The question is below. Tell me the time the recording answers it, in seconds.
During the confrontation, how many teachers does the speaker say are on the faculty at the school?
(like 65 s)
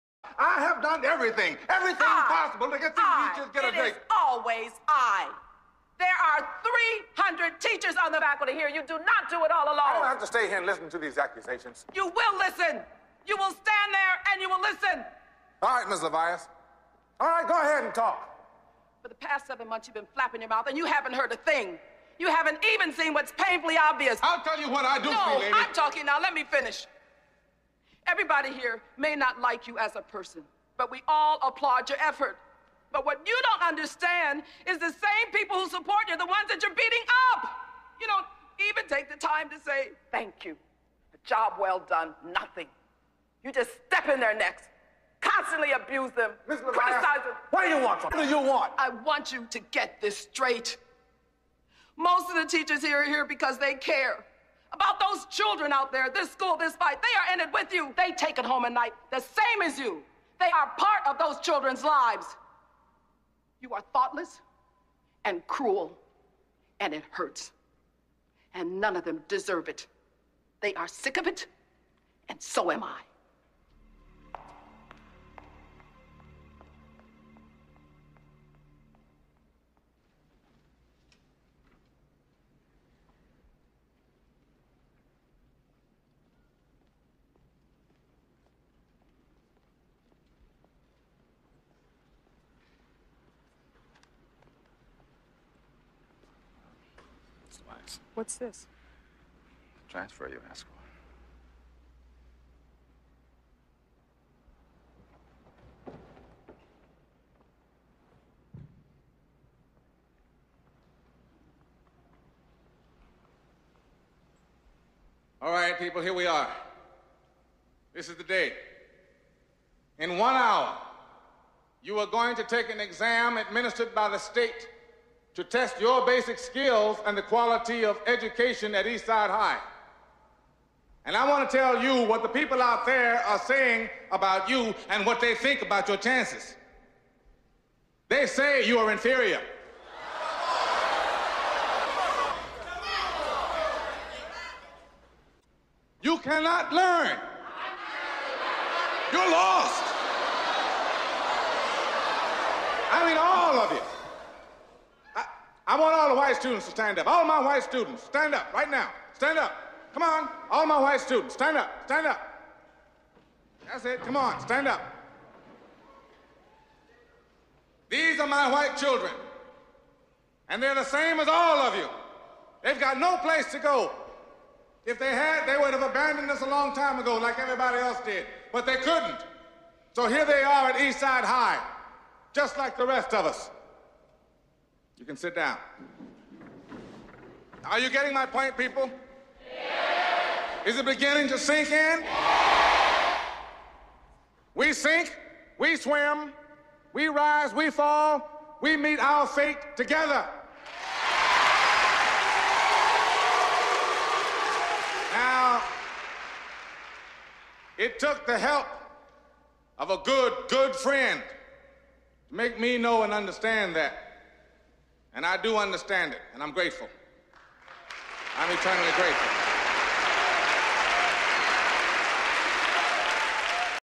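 7 s.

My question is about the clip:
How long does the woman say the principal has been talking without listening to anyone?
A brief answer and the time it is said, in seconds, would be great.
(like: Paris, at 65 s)
seven months, at 19 s.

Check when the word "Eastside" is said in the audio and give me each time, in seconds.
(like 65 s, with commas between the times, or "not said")
128 s, 180 s.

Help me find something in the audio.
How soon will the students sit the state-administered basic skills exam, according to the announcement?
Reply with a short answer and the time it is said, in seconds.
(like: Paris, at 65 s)
one hour, at 120 s.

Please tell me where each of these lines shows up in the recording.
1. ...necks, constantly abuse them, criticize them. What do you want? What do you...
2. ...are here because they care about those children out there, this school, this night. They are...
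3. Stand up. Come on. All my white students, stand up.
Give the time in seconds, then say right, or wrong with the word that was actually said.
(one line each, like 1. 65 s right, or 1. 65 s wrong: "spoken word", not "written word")
1. 44 s right
2. 53 s wrong: "fight", not "night"
3. 159 s right.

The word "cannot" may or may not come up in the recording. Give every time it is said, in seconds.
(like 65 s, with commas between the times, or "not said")
146 s.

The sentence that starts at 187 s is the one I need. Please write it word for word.
Are you getting my point, people?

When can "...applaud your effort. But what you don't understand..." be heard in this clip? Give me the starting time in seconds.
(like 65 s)
31 s.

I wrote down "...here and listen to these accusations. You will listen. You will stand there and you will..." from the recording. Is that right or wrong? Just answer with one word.
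right.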